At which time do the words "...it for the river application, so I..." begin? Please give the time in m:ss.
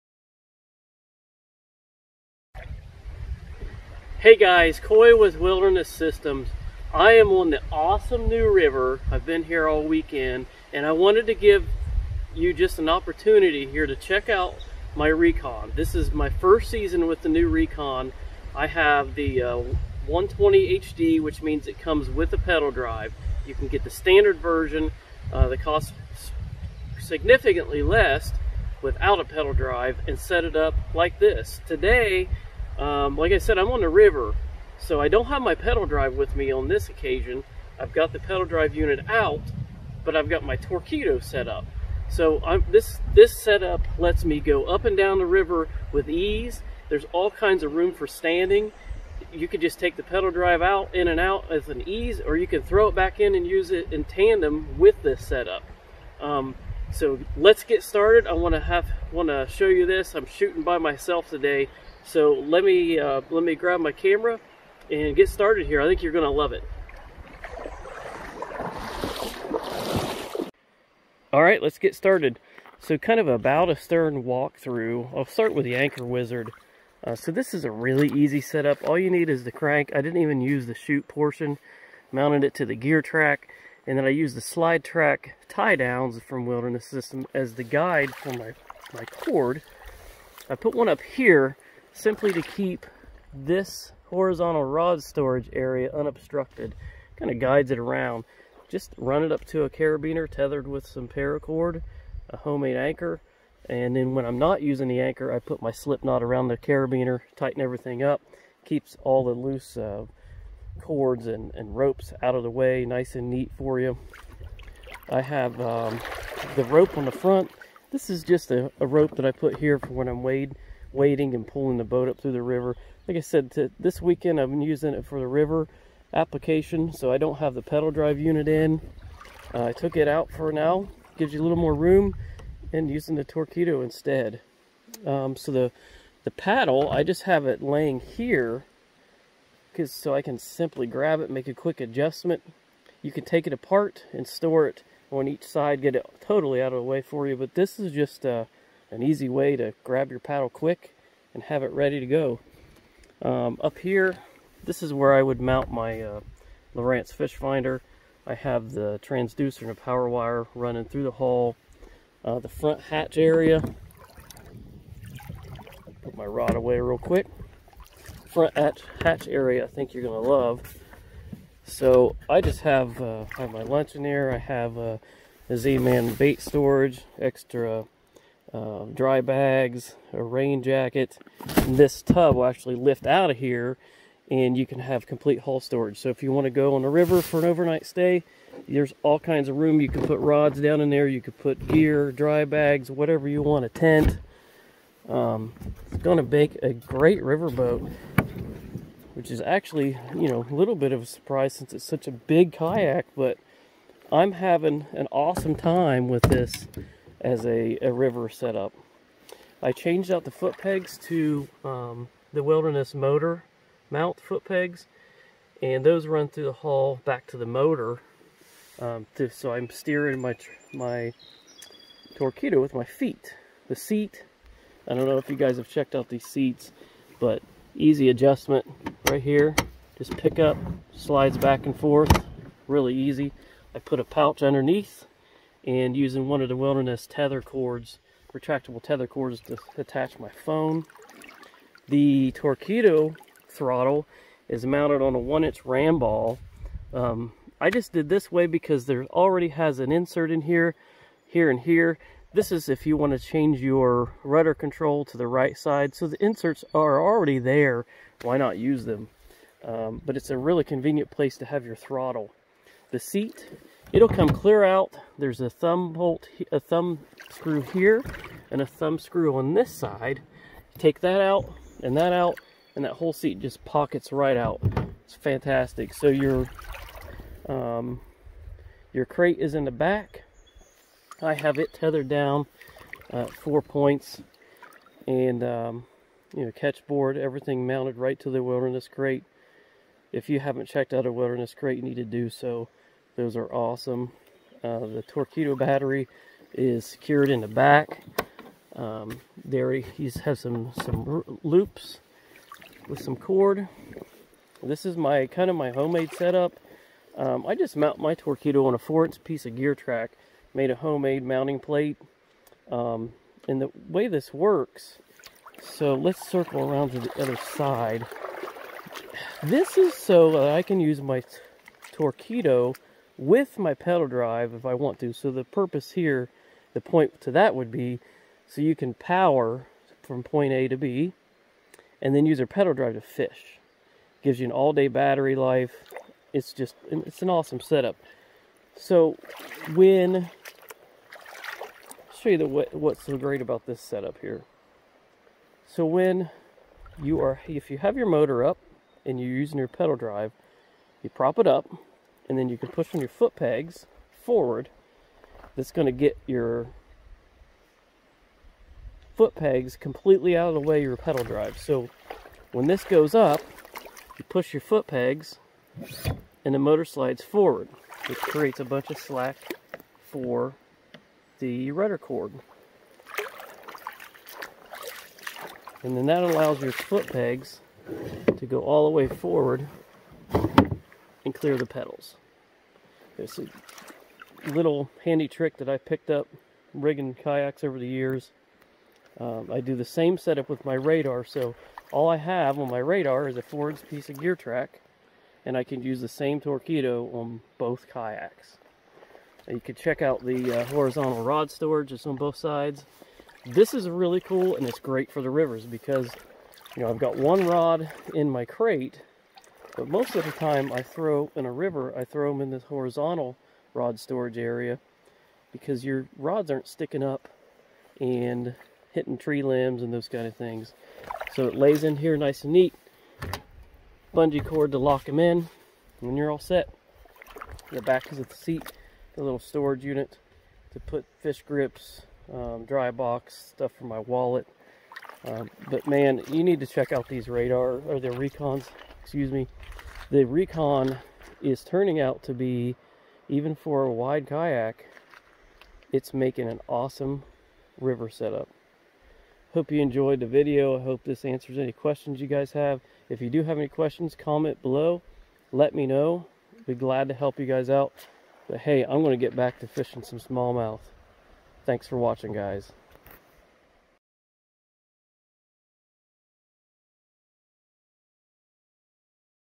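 2:04.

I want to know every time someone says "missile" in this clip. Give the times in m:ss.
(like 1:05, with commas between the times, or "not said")
not said.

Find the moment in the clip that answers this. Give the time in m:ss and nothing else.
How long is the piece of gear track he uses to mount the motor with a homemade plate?
5:08.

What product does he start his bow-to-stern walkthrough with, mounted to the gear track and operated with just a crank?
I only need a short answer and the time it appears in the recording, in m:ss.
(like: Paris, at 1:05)
Anchor Wizard, at 1:15.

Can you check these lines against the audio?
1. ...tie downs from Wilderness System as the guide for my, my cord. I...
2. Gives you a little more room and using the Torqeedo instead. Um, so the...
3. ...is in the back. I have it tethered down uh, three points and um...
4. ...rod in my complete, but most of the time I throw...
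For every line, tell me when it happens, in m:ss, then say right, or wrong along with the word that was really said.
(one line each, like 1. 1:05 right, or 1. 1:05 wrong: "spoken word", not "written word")
1. 1:25 right
2. 2:11 right
3. 4:39 wrong: "four", not "three"
4. 6:47 wrong: "crate", not "complete".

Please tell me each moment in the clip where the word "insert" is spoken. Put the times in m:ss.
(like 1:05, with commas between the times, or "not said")
4:09, 4:16.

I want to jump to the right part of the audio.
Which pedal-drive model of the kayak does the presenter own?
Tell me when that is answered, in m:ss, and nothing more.
0:20.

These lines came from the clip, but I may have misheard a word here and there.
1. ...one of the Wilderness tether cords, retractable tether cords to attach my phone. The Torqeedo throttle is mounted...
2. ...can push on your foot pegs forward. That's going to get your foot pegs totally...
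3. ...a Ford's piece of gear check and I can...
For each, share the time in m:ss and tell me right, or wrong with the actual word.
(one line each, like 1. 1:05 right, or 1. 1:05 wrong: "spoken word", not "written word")
1. 3:56 right
2. 5:52 wrong: "completely", not "totally"
3. 6:33 wrong: "track", not "check".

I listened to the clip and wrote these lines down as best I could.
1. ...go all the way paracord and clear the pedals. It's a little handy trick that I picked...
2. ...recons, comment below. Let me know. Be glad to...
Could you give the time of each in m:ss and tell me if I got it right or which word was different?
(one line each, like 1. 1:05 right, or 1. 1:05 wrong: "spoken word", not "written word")
1. 6:18 wrong: "forward", not "paracord"
2. 7:33 wrong: "questions", not "recons".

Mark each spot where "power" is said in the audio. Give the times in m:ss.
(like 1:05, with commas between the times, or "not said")
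2:39, 5:28.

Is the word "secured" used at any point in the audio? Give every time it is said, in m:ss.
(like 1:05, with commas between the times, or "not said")
4:56.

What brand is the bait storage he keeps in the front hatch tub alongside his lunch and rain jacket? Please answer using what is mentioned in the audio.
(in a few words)
Z-Man.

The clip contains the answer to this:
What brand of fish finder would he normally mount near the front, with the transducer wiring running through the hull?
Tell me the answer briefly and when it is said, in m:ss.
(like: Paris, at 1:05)
Lowrance, at 2:36.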